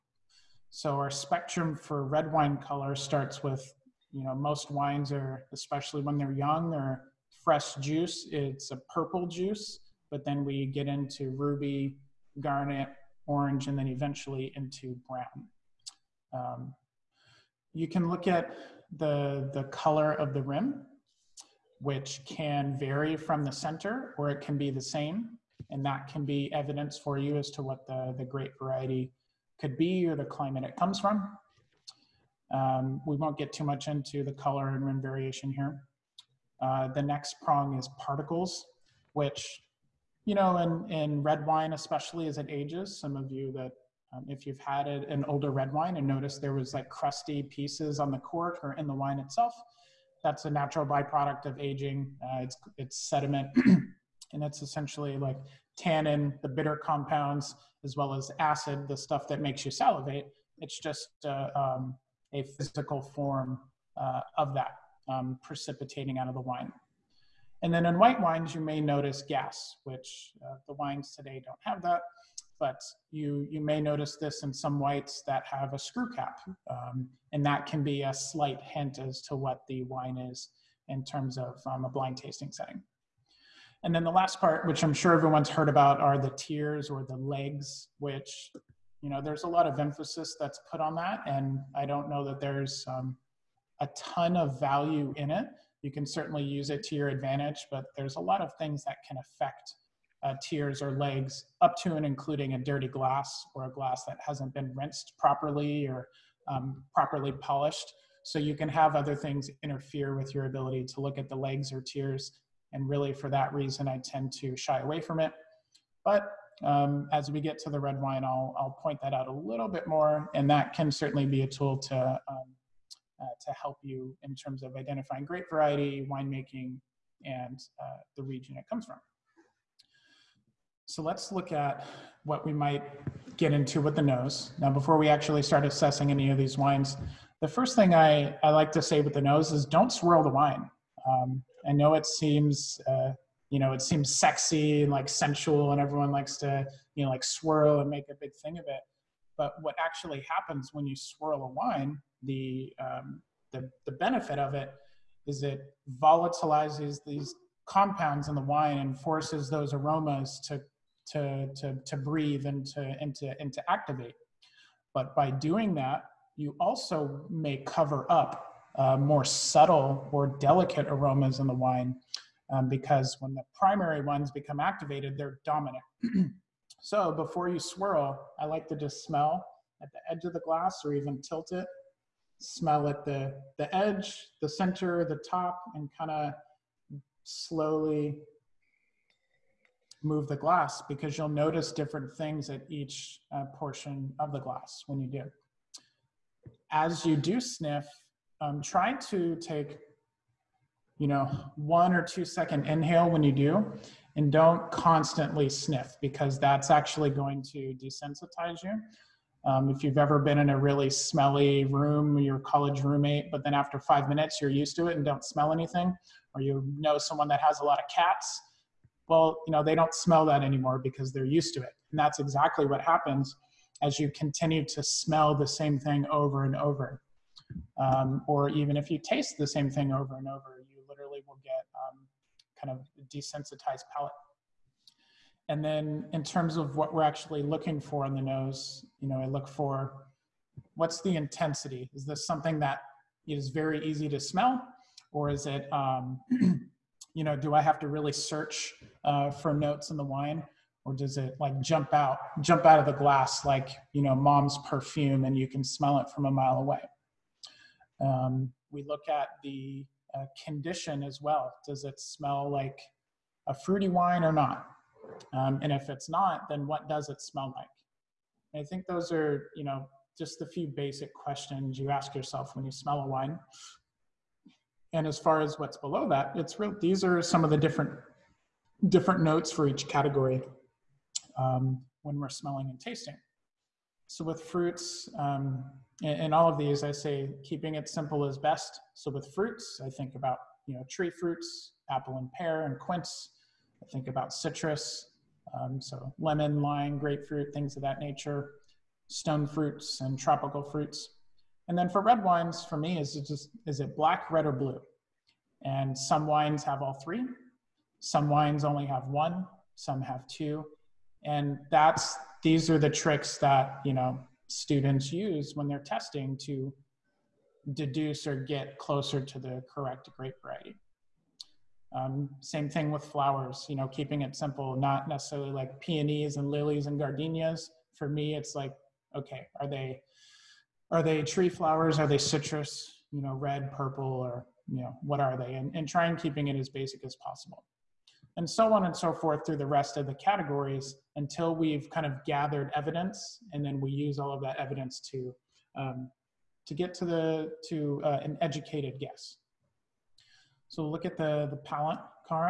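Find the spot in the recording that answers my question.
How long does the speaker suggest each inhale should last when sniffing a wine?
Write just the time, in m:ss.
3:21.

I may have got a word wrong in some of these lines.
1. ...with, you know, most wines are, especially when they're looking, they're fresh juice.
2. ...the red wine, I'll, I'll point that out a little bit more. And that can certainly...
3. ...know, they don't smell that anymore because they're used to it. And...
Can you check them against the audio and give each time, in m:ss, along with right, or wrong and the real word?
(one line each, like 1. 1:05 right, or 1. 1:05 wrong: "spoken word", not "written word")
1. 0:03 wrong: "young", not "looking"
2. 1:57 right
3. 3:39 right.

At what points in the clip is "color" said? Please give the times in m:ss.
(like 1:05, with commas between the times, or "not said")
0:02, 0:19, 0:34.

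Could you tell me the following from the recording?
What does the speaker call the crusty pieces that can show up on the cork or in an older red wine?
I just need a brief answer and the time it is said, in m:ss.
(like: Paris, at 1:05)
Sediment, at 0:53.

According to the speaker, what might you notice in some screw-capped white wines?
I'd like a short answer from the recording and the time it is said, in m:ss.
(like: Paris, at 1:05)
Gas, at 1:09.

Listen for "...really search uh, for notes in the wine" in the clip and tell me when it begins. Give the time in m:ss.
4:07.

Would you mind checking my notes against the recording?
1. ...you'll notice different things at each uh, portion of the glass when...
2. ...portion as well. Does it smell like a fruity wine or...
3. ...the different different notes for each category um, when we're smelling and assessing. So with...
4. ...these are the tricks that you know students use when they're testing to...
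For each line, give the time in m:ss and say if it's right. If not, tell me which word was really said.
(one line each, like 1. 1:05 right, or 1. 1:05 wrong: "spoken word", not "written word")
1. 3:11 right
2. 4:20 wrong: "condition", not "portion"
3. 4:37 wrong: "tasting", not "assessing"
4. 5:12 right.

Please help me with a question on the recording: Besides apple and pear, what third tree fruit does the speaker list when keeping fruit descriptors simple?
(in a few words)
Quince.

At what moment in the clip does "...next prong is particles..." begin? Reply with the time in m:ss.
0:37.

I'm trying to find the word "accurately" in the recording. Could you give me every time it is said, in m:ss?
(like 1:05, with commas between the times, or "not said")
not said.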